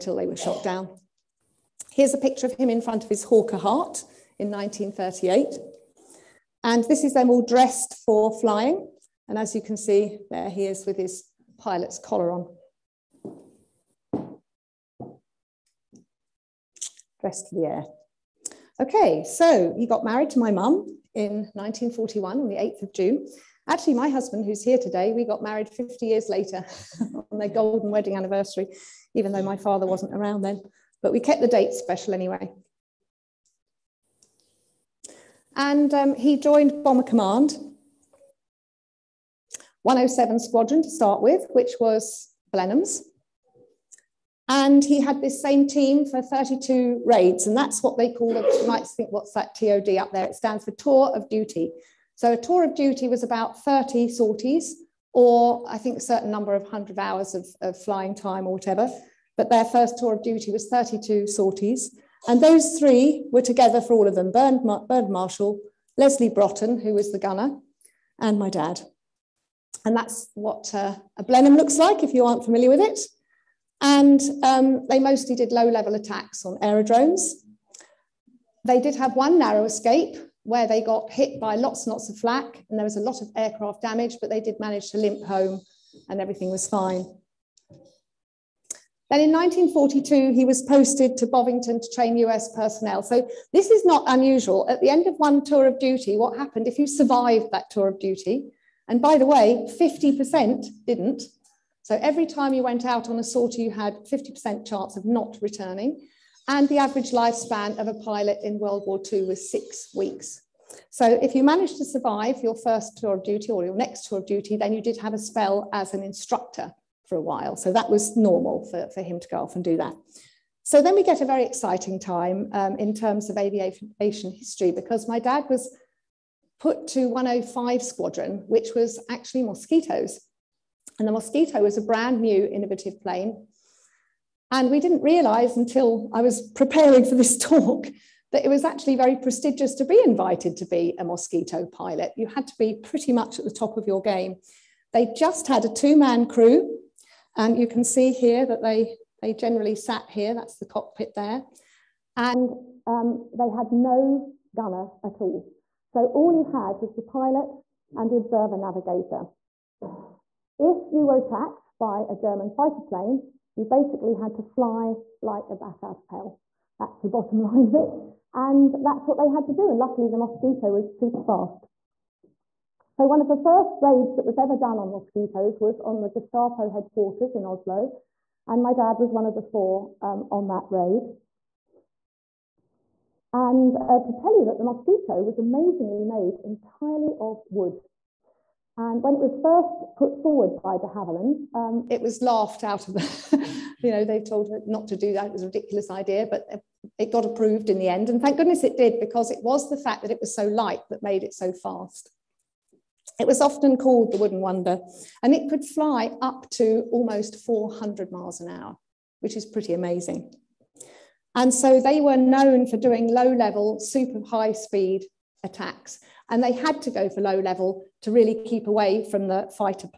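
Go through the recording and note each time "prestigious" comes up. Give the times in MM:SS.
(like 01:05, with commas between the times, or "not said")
02:19.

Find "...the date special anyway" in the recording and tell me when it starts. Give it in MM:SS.
00:31.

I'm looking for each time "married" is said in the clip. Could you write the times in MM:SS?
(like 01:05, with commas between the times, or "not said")
00:20, 00:25.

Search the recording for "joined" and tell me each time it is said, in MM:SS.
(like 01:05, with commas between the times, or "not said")
00:36.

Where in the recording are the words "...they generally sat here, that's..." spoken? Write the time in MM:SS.
02:29.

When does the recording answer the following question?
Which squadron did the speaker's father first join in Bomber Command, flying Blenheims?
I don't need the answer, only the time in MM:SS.
00:39.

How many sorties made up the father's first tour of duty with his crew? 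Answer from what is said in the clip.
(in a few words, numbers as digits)
32.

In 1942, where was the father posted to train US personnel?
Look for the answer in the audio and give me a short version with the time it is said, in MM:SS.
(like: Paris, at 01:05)
Bovingdon, at 01:31.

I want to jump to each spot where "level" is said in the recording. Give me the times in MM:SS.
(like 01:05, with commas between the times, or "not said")
01:15, 03:33, 03:37.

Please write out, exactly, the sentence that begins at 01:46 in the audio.
And the average lifespan of a pilot in World War II was six weeks.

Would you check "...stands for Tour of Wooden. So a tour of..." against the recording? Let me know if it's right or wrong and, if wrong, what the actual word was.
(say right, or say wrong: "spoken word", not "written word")
wrong: "Duty", not "Wooden".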